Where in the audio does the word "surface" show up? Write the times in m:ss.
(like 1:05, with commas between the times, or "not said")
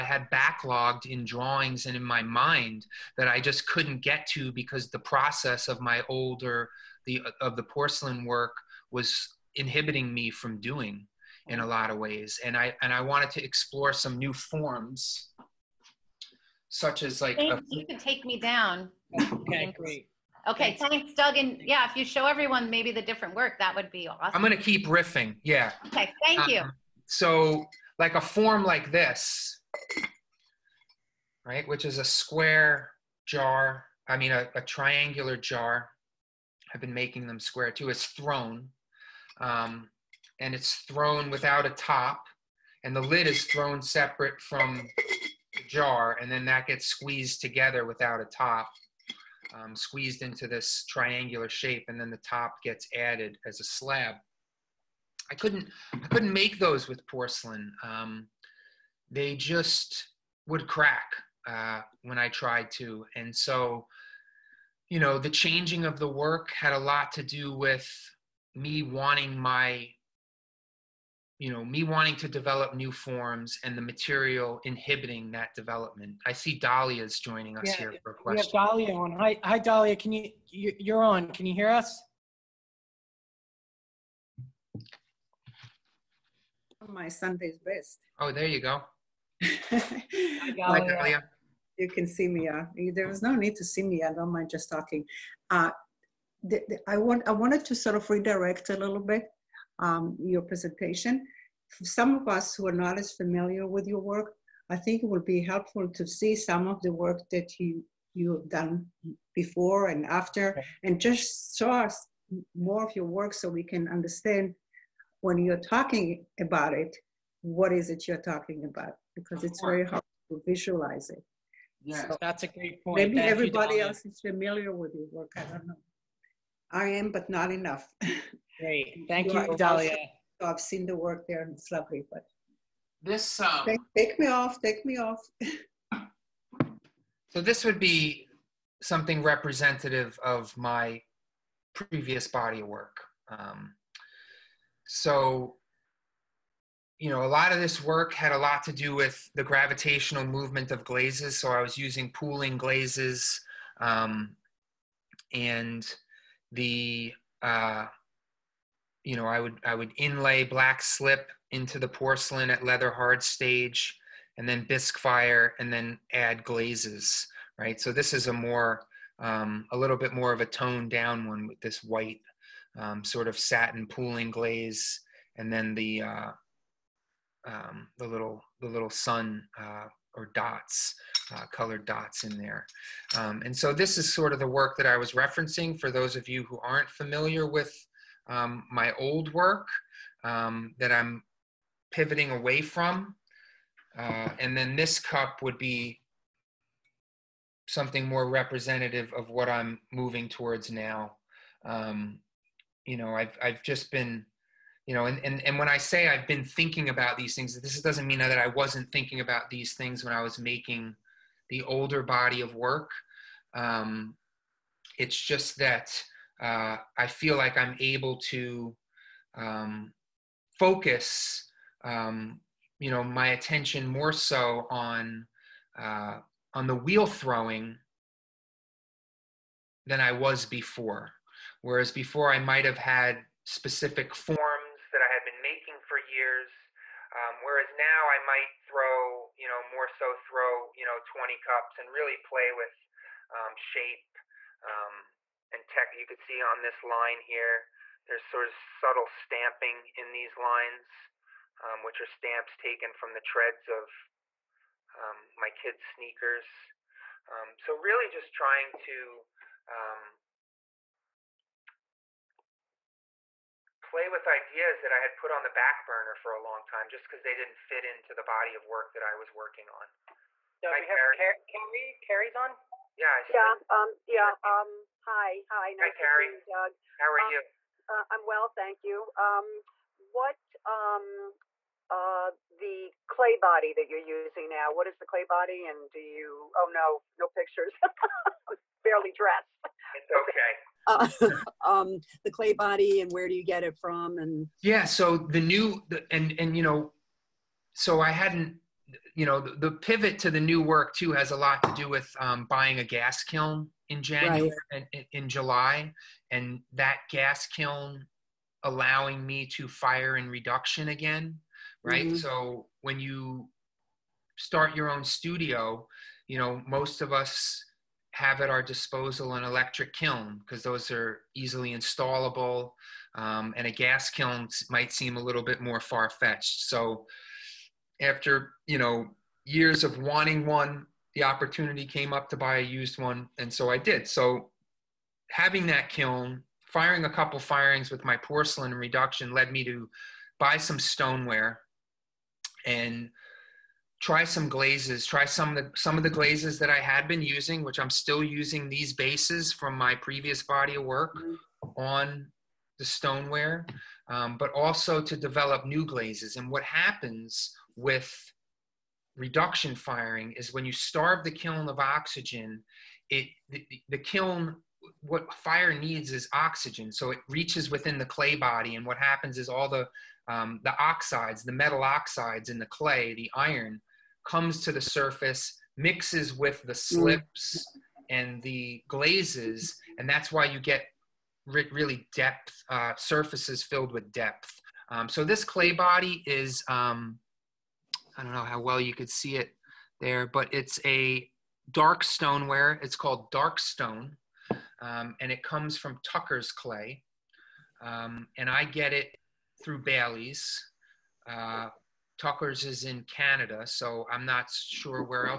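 6:14, 6:22.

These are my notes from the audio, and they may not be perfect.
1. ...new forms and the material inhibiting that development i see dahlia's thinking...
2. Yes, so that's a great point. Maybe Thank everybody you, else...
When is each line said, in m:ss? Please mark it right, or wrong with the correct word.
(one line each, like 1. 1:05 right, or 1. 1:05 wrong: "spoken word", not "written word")
1. 1:12 wrong: "joining", not "thinking"
2. 2:01 right.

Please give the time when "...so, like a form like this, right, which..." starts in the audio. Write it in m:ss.
0:27.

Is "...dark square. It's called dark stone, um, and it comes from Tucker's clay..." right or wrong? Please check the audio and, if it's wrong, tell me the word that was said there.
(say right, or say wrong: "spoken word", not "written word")
wrong: "stoneware", not "square".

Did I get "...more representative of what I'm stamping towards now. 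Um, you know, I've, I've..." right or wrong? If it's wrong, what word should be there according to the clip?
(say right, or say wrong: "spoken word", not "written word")
wrong: "moving", not "stamping".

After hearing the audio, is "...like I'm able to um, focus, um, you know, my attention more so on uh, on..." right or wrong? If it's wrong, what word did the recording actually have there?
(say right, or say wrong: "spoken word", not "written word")
right.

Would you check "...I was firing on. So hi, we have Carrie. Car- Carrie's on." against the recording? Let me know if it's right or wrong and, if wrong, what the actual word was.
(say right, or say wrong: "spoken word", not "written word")
wrong: "working", not "firing".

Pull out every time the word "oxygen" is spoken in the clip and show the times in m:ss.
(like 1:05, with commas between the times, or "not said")
6:01, 6:06.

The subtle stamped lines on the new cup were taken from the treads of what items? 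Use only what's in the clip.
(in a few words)
Kids' sneakers.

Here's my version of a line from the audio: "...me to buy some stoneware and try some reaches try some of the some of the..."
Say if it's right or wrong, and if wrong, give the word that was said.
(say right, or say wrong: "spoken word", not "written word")
wrong: "glazes", not "reaches".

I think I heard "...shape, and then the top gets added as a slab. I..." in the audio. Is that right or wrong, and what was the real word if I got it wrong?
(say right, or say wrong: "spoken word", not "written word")
right.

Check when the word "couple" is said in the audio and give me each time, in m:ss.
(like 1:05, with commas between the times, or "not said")
5:37.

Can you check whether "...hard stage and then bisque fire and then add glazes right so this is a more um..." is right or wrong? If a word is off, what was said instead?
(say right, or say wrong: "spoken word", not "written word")
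right.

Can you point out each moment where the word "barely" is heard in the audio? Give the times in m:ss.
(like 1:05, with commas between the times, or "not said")
4:48.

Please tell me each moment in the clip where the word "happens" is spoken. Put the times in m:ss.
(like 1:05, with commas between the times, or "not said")
5:56, 6:08.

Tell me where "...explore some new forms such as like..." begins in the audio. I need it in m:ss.
0:13.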